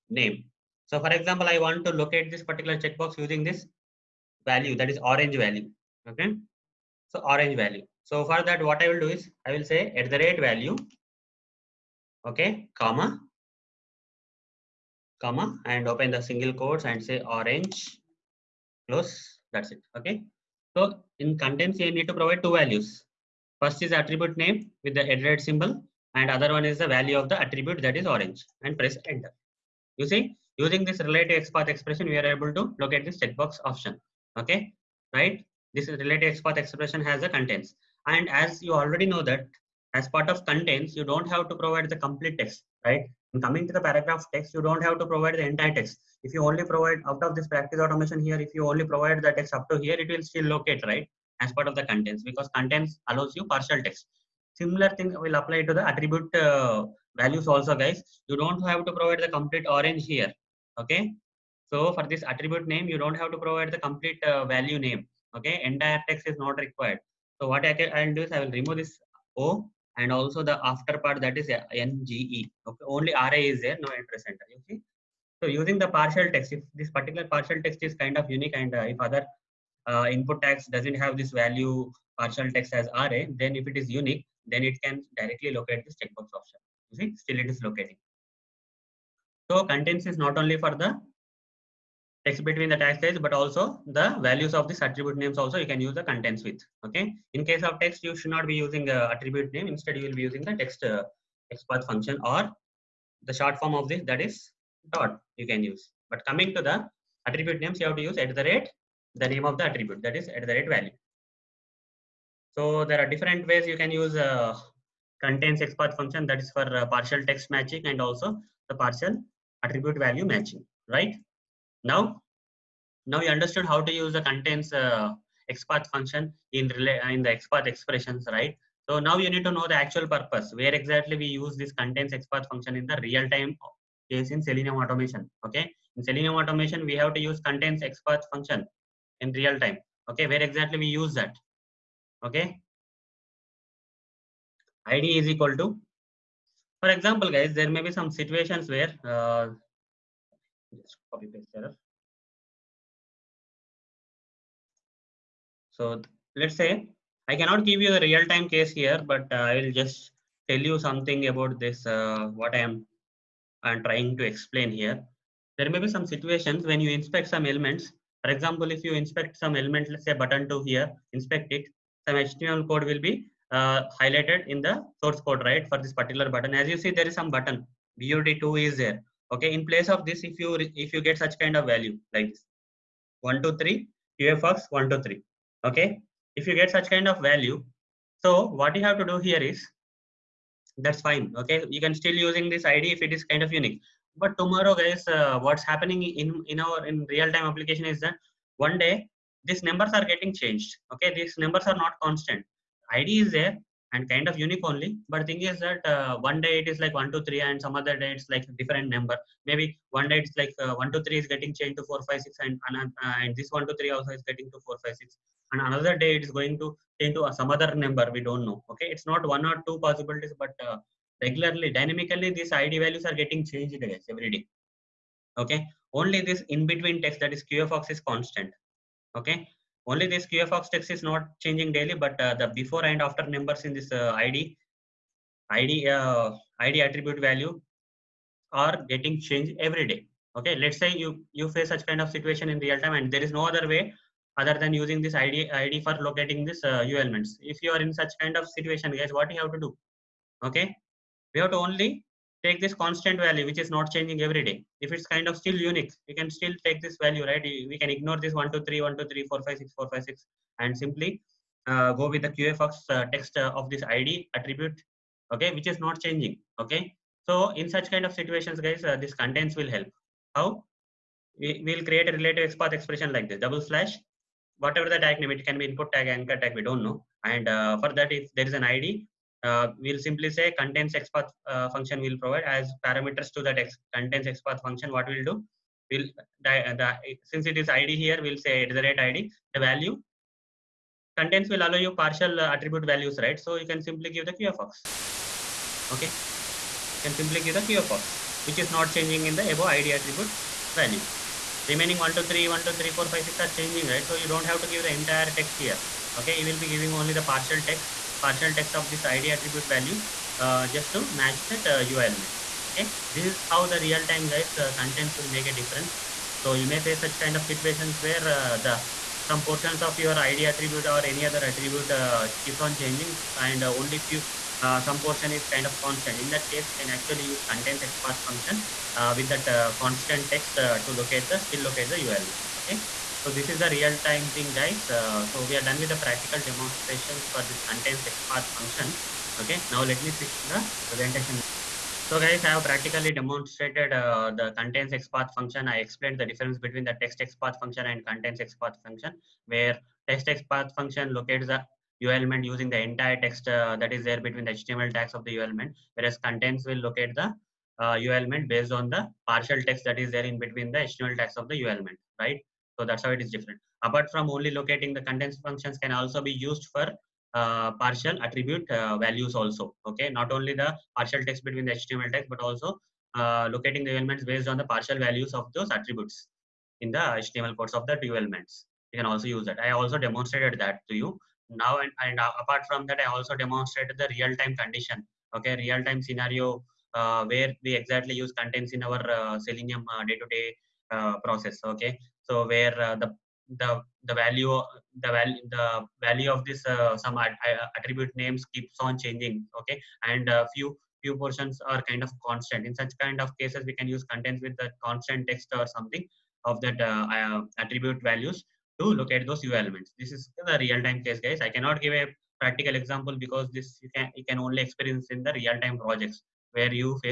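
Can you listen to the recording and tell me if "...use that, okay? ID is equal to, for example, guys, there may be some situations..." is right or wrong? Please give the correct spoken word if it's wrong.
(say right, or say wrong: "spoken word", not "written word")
right.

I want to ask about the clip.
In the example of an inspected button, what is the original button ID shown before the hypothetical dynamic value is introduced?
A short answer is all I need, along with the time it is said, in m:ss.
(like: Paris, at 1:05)
BUD2, at 2:57.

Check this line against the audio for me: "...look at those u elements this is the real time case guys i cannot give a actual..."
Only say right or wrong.
wrong.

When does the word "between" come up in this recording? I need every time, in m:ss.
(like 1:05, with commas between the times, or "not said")
1:32, 3:46, 5:46, 5:54, 6:00, 6:11.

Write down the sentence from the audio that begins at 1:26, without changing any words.
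You see, still it is locating.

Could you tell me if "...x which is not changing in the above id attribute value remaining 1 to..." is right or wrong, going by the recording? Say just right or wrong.
right.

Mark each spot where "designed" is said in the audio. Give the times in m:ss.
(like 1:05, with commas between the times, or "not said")
not said.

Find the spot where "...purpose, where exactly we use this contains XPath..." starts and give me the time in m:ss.
2:10.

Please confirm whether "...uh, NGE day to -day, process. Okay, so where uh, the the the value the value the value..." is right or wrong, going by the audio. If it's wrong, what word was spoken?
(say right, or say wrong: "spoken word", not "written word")
wrong: "Selenium", not "NGE".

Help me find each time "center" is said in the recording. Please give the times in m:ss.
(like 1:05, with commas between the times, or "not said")
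1:14.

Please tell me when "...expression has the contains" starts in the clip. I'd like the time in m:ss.
0:36.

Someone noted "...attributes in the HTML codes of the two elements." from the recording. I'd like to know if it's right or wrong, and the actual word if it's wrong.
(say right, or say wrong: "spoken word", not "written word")
right.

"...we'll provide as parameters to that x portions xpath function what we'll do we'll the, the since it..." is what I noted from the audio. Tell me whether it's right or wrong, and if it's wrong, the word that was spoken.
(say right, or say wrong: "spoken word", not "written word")
wrong: "contains", not "portions".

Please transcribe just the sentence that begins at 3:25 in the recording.
But thing is that uh, one day it is like one two three, and some other day it's like different number.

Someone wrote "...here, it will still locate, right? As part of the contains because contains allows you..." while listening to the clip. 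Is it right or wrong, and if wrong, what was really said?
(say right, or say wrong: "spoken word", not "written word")
right.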